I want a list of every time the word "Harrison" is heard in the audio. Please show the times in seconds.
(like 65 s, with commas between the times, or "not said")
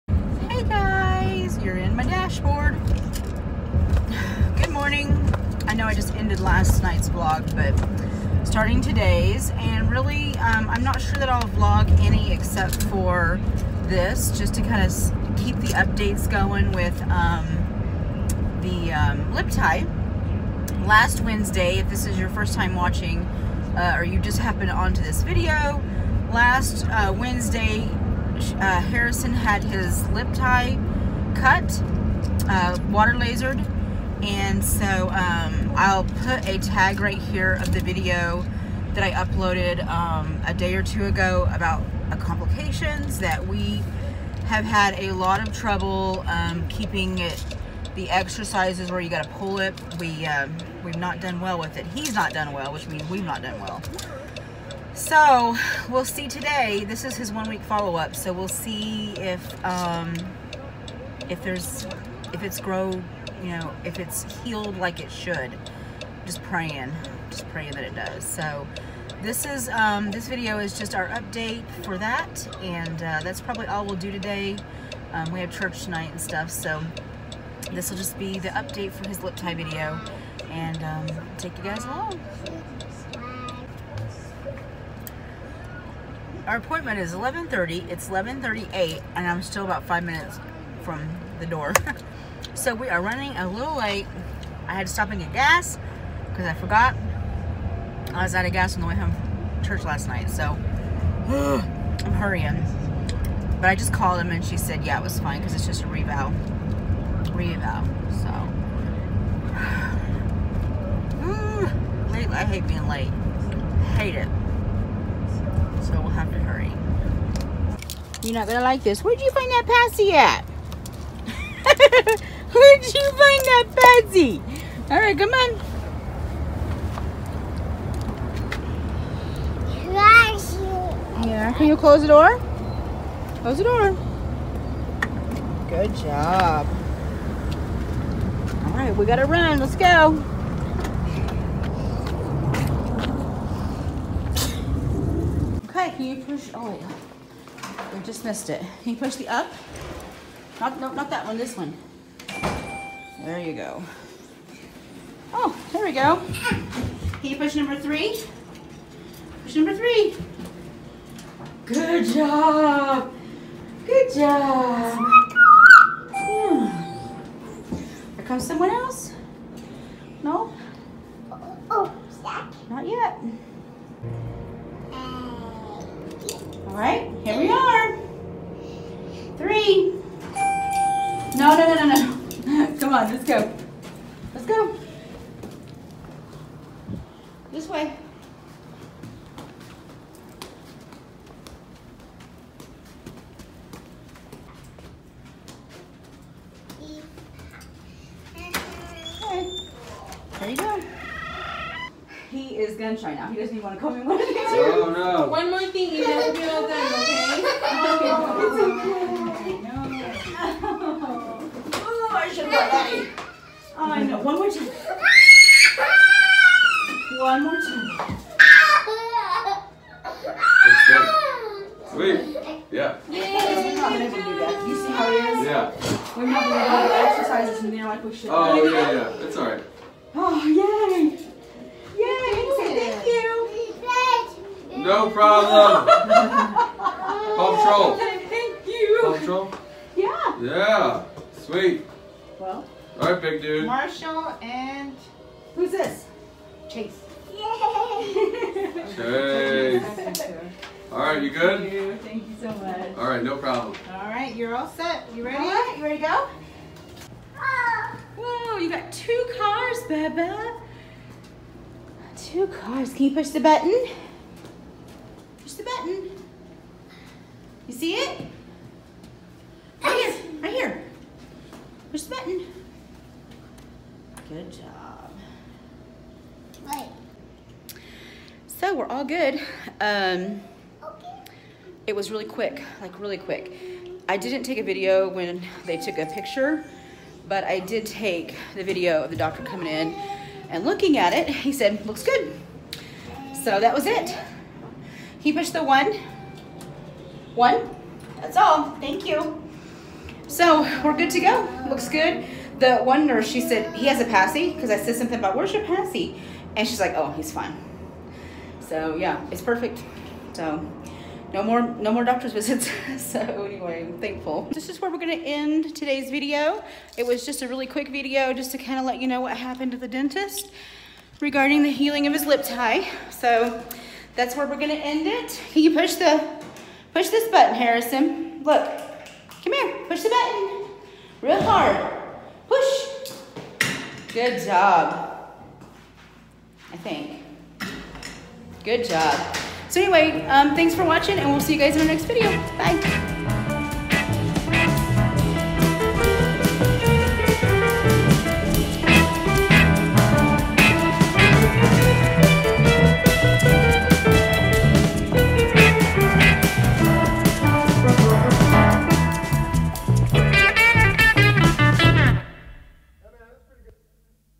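28 s, 327 s.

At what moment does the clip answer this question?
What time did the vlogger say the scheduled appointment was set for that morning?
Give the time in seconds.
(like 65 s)
87 s.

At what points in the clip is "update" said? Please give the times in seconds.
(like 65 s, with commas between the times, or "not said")
15 s, 71 s, 78 s.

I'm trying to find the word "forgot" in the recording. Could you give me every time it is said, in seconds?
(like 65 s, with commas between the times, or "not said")
96 s.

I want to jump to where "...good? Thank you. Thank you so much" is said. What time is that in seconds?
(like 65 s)
251 s.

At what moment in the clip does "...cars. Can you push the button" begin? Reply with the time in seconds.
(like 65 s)
262 s.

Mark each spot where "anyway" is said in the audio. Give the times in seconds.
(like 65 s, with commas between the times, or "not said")
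313 s, 339 s.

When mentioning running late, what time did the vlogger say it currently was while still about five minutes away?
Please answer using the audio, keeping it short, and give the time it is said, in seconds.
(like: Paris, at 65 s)
11:38, at 88 s.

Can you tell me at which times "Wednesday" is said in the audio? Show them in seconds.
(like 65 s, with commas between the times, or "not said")
21 s, 27 s.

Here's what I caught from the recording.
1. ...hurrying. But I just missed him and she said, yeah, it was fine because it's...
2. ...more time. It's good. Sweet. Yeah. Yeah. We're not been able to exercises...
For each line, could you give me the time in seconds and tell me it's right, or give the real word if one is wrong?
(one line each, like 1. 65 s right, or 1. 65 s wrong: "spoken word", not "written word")
1. 102 s wrong: "called", not "missed"
2. 217 s right.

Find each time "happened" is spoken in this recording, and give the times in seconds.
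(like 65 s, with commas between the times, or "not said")
24 s, 319 s.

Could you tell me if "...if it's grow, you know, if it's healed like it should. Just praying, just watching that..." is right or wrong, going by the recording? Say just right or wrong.
wrong.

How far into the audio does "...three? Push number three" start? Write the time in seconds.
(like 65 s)
157 s.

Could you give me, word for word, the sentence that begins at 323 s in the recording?
So that's where we're gonna end it.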